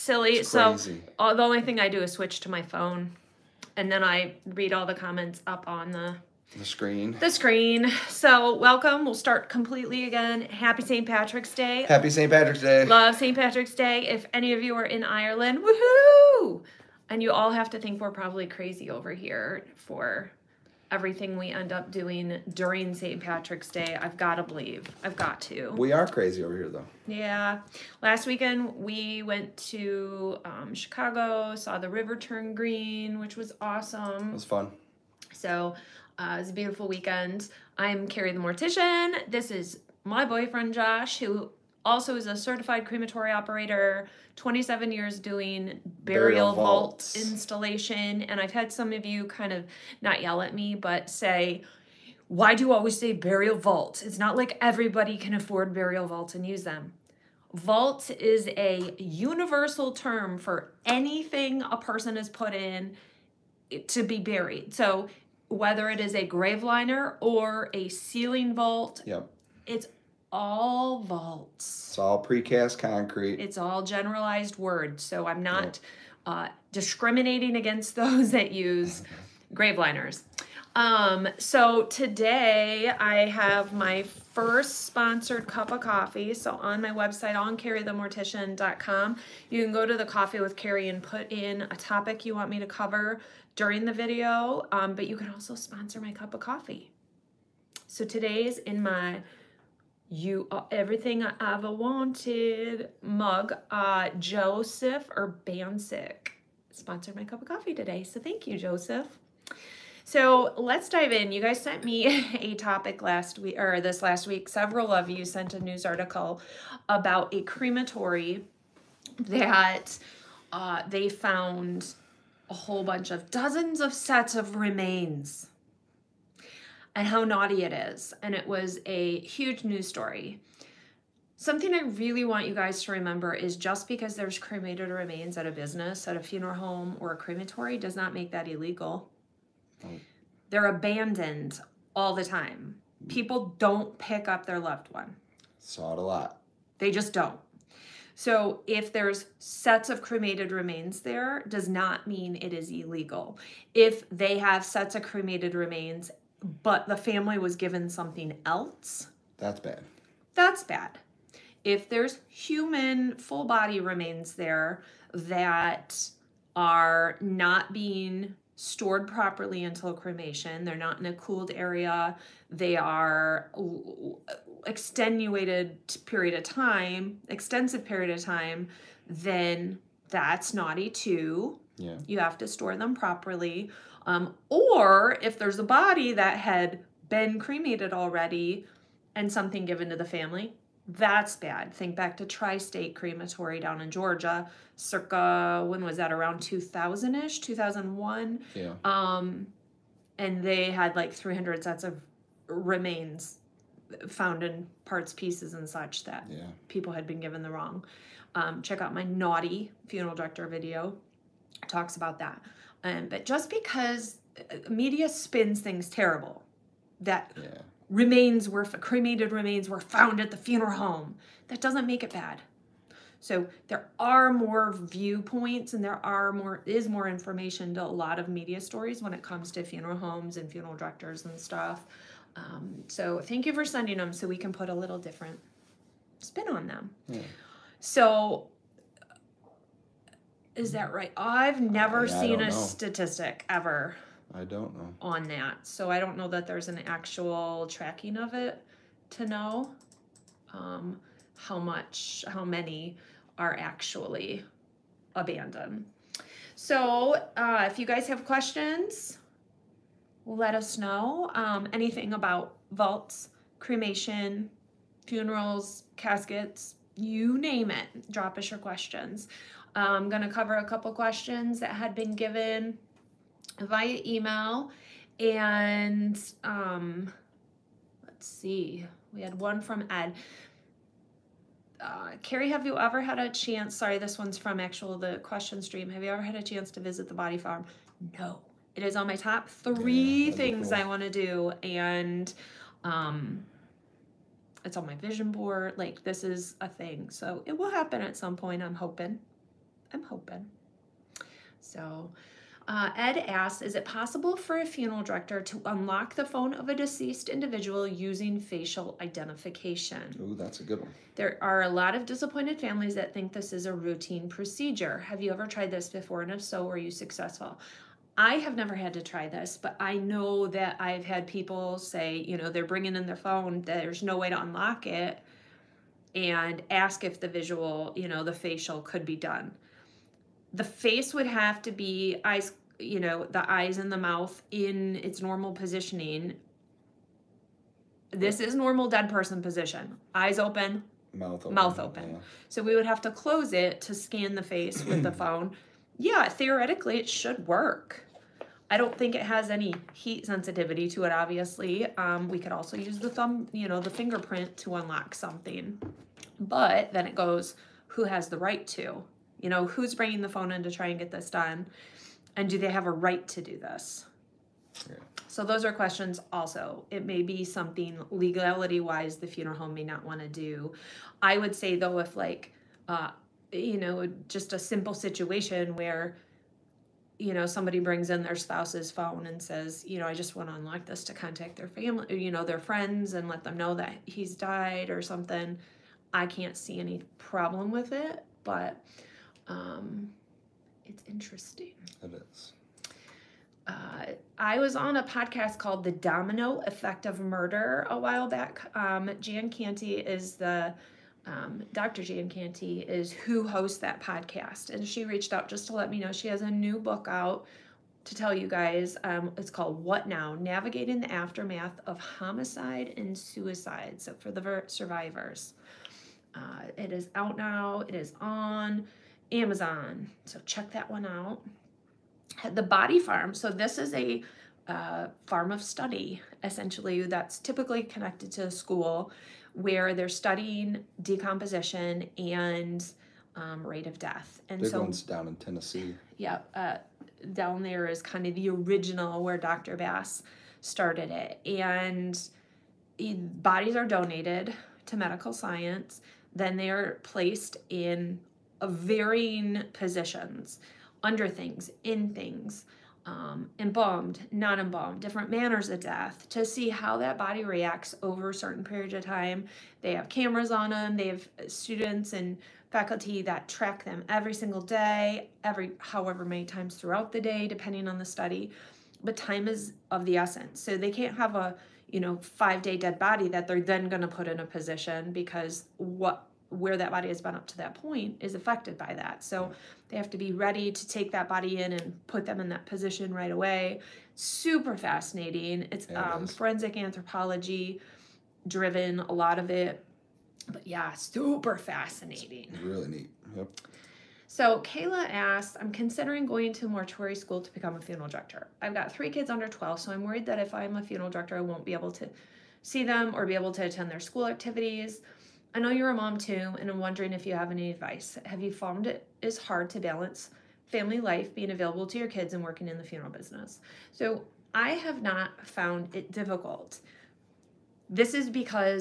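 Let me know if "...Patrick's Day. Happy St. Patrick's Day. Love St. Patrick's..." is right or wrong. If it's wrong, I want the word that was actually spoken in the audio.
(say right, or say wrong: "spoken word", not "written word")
right.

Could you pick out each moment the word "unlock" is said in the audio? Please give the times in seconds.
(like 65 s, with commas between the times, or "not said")
305 s, 324 s, 354 s, 380 s.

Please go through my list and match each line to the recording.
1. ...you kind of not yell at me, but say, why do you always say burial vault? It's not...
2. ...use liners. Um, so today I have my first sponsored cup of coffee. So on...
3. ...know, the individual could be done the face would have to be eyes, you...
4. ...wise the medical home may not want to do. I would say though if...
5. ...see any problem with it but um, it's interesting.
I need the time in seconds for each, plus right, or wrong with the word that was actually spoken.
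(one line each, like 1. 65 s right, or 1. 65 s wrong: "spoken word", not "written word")
1. 49 s right
2. 78 s right
3. 328 s wrong: "facial", not "individual"
4. 368 s wrong: "funeral", not "medical"
5. 386 s right.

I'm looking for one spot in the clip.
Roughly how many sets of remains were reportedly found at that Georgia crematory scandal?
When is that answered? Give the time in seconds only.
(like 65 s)
201 s.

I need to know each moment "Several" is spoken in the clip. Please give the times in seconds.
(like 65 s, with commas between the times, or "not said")
114 s.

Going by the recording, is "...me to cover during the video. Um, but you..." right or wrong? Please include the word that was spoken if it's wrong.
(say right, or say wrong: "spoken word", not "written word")
right.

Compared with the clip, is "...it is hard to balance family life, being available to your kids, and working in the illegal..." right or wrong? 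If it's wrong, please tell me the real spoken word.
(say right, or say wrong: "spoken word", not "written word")
wrong: "funeral", not "illegal".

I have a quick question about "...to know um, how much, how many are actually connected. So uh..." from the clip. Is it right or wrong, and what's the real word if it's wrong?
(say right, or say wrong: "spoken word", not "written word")
wrong: "abandoned", not "connected".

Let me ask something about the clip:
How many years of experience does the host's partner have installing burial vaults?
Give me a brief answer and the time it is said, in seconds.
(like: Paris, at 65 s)
27, at 44 s.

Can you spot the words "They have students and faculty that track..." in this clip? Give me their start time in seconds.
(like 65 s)
460 s.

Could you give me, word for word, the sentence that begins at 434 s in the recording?
And Big so, one's down in Tennessee.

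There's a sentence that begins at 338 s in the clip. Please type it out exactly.
This is normal dead person position.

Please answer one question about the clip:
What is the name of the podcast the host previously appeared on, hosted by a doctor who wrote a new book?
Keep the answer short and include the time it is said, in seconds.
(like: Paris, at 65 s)
The Domino Effect of Murder, at 395 s.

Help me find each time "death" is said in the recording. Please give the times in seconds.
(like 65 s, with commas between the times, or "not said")
433 s, 455 s.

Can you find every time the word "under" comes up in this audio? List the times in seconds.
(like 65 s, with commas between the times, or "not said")
451 s, 499 s.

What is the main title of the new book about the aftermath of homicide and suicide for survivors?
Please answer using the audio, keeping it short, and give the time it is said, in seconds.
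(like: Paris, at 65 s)
What Now?, at 409 s.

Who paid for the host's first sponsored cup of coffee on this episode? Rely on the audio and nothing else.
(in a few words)
Joseph Urbansic.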